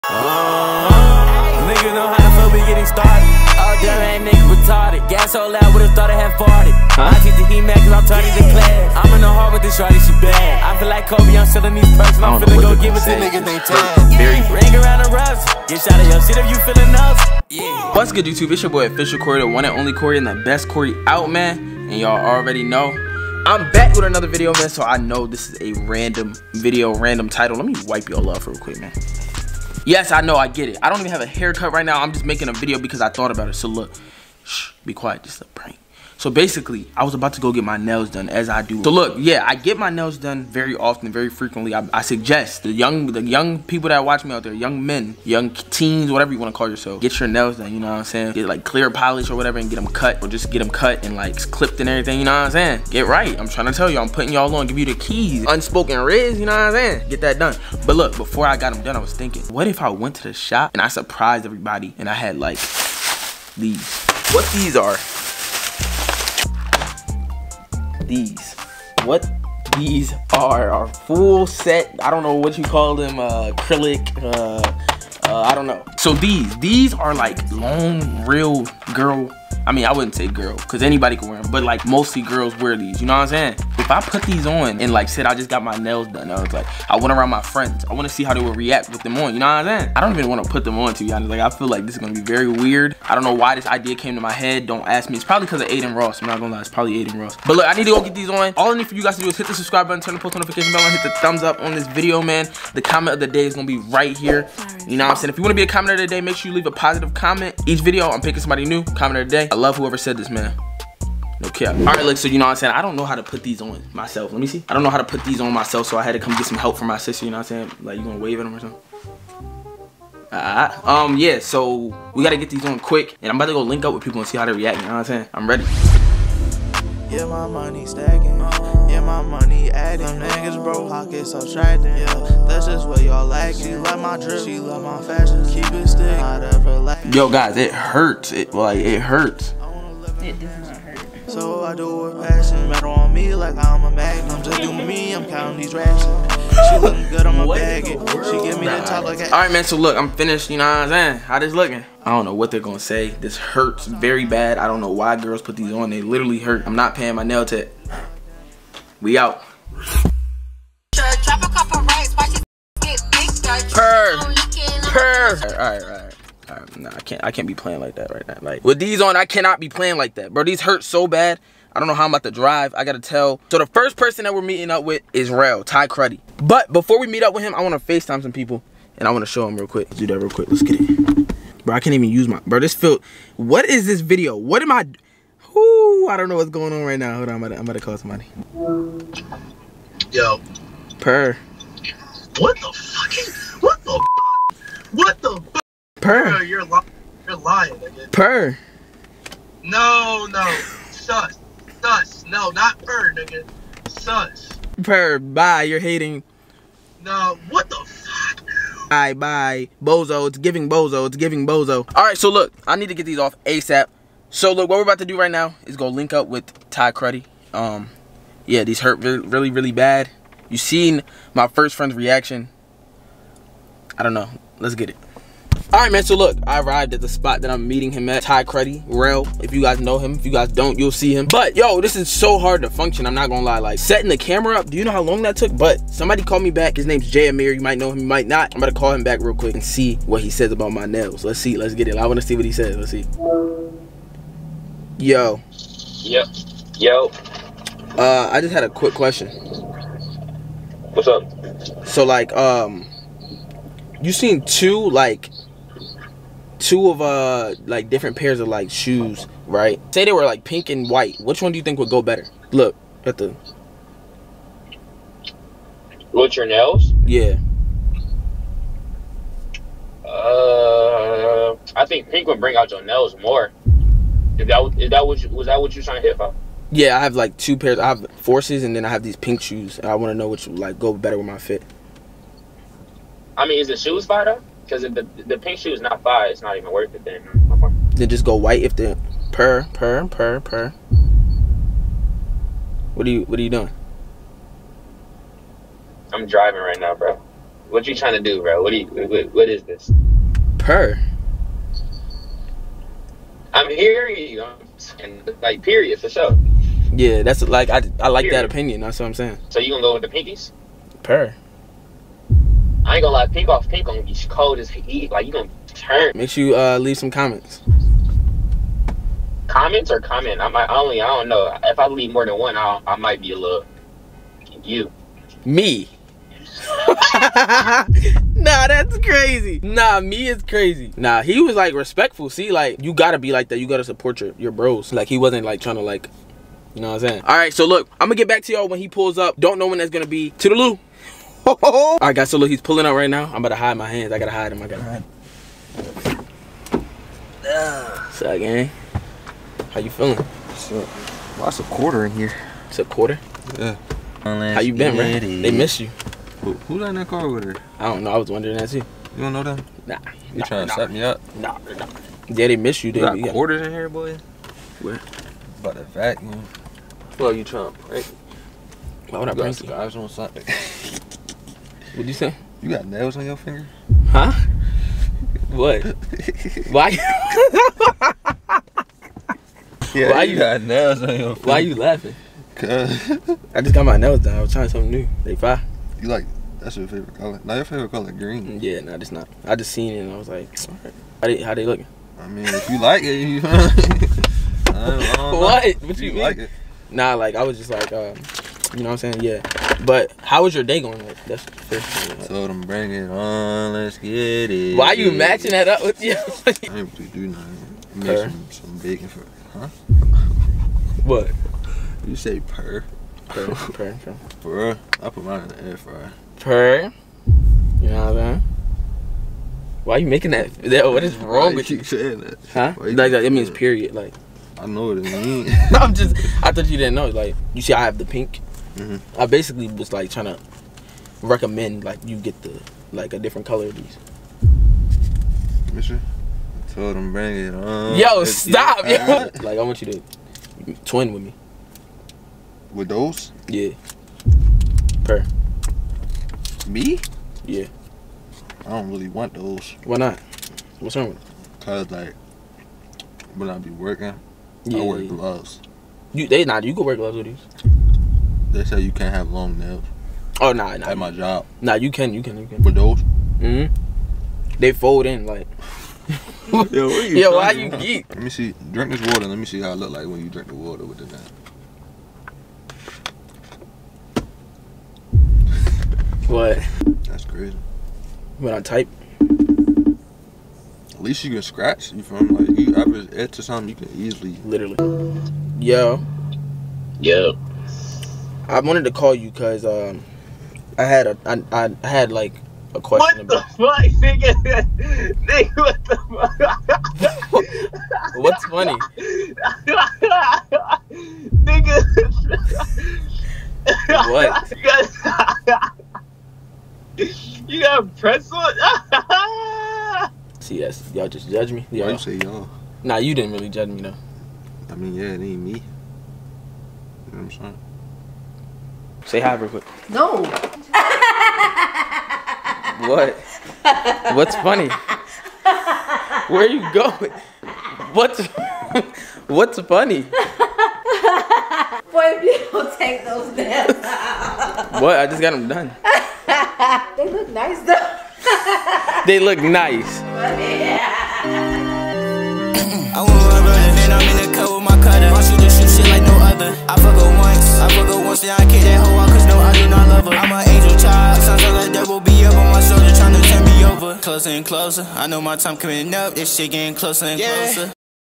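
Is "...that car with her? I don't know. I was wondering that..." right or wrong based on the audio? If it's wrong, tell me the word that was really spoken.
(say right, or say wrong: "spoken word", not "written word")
right.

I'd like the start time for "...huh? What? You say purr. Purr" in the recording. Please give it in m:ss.
6:49.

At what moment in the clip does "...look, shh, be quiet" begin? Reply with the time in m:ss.
0:33.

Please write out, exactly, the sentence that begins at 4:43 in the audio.
I mean, is it shoes by though?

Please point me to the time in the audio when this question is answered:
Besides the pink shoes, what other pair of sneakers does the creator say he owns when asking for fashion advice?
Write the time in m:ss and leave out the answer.
4:38.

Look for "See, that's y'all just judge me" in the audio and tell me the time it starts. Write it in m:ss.
8:30.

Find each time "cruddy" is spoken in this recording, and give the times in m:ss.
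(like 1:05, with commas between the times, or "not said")
2:55, 3:36, 3:48.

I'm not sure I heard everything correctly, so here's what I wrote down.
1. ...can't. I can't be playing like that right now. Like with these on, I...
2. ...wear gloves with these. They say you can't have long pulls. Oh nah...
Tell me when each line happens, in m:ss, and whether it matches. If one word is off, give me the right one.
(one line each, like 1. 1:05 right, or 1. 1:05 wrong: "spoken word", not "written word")
1. 2:46 right
2. 7:36 wrong: "nails", not "pulls".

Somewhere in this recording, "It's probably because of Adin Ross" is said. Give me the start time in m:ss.
1:35.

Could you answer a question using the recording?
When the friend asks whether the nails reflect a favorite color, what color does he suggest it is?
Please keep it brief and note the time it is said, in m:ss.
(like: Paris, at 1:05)
Green, at 6:28.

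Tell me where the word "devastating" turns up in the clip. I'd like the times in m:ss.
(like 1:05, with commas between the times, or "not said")
not said.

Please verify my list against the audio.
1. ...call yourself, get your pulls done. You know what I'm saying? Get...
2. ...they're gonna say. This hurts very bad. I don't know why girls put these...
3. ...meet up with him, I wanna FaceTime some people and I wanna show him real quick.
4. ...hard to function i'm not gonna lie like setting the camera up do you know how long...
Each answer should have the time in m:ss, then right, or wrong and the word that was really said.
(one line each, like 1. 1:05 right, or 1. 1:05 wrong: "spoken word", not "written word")
1. 0:46 wrong: "nails", not "pulls"
2. 2:32 right
3. 2:57 right
4. 3:52 right.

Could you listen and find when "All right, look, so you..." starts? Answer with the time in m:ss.
1:51.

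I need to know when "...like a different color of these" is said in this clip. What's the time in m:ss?
7:12.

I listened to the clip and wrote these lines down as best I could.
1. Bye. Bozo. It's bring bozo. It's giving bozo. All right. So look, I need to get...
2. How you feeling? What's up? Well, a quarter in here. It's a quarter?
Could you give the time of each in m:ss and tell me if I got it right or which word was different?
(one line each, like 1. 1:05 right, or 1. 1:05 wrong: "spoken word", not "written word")
1. 3:29 wrong: "giving", not "bring"
2. 5:49 right.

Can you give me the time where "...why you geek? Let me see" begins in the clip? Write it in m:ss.
7:47.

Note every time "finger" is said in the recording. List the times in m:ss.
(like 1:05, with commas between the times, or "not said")
6:13, 6:21.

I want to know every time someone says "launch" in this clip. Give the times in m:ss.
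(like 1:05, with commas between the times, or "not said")
not said.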